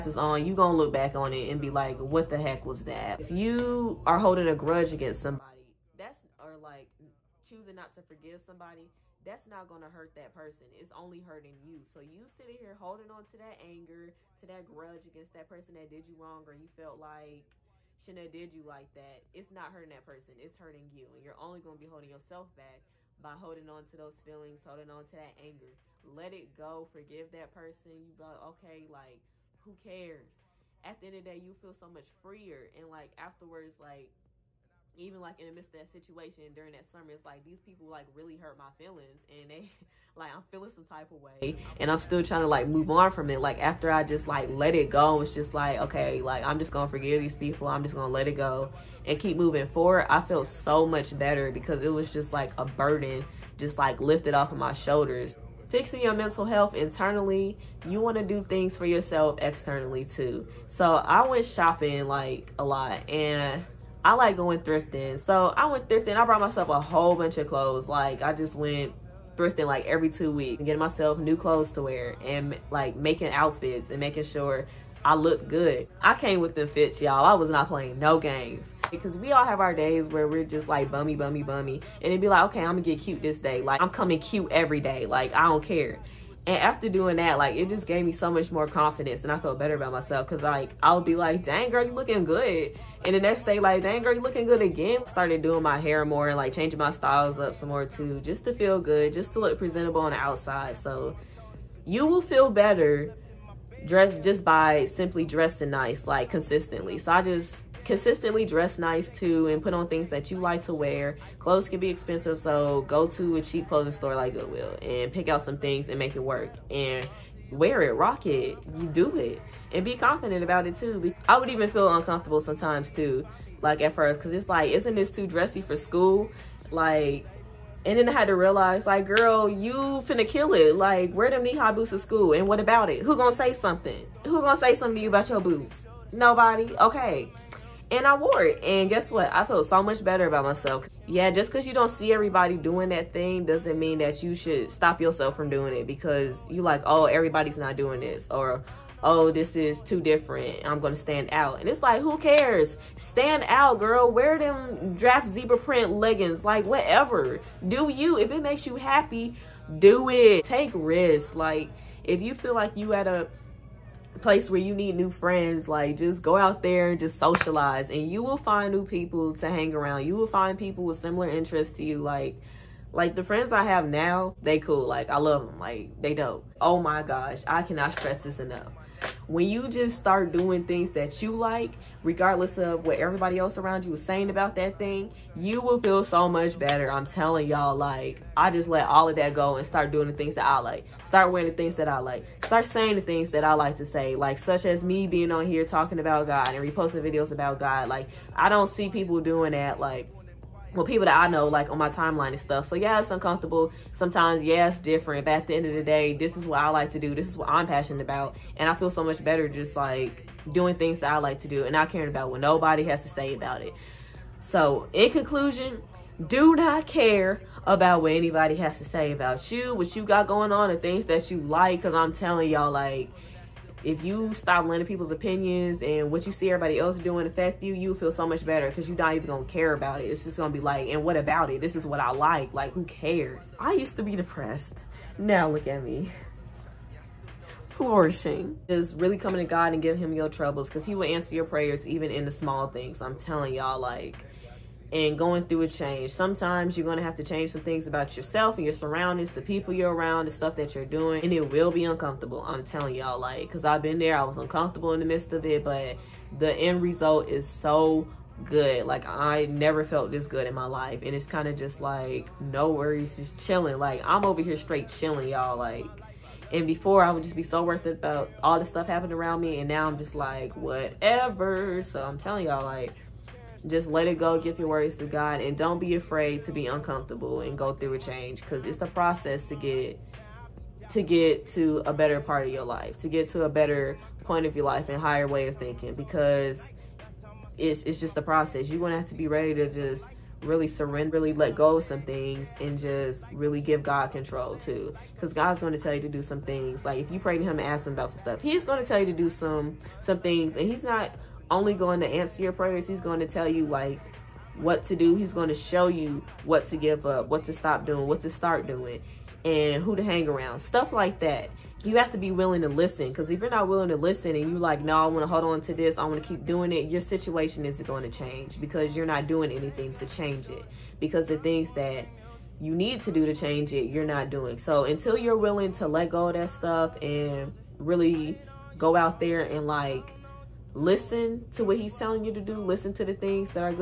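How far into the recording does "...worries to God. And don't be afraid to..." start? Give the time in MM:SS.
04:34.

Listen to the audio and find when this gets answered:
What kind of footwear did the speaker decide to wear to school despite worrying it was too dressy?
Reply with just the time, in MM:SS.
02:11.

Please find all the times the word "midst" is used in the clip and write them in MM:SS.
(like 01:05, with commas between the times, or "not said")
00:35, 04:15.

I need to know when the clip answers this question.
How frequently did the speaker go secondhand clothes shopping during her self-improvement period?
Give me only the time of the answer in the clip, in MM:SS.
01:09.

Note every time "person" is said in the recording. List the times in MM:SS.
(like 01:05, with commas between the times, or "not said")
00:10, 00:15, 00:20, 00:27.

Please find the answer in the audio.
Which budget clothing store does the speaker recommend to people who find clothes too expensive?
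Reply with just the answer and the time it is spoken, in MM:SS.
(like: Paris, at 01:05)
Goodwill, at 01:54.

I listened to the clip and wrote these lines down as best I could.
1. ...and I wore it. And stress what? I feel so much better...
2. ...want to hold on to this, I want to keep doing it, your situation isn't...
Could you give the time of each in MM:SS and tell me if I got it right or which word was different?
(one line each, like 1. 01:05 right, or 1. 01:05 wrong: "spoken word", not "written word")
1. 02:17 wrong: "guess", not "stress"
2. 05:15 right.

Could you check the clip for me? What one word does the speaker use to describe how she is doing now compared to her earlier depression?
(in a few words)
Flourishing.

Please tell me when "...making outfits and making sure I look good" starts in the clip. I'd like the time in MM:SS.
01:12.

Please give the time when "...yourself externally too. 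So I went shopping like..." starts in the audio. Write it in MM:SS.
00:58.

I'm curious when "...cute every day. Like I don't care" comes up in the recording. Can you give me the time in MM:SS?
01:24.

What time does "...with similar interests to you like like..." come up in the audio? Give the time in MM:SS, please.
02:50.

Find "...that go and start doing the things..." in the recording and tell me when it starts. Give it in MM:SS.
03:09.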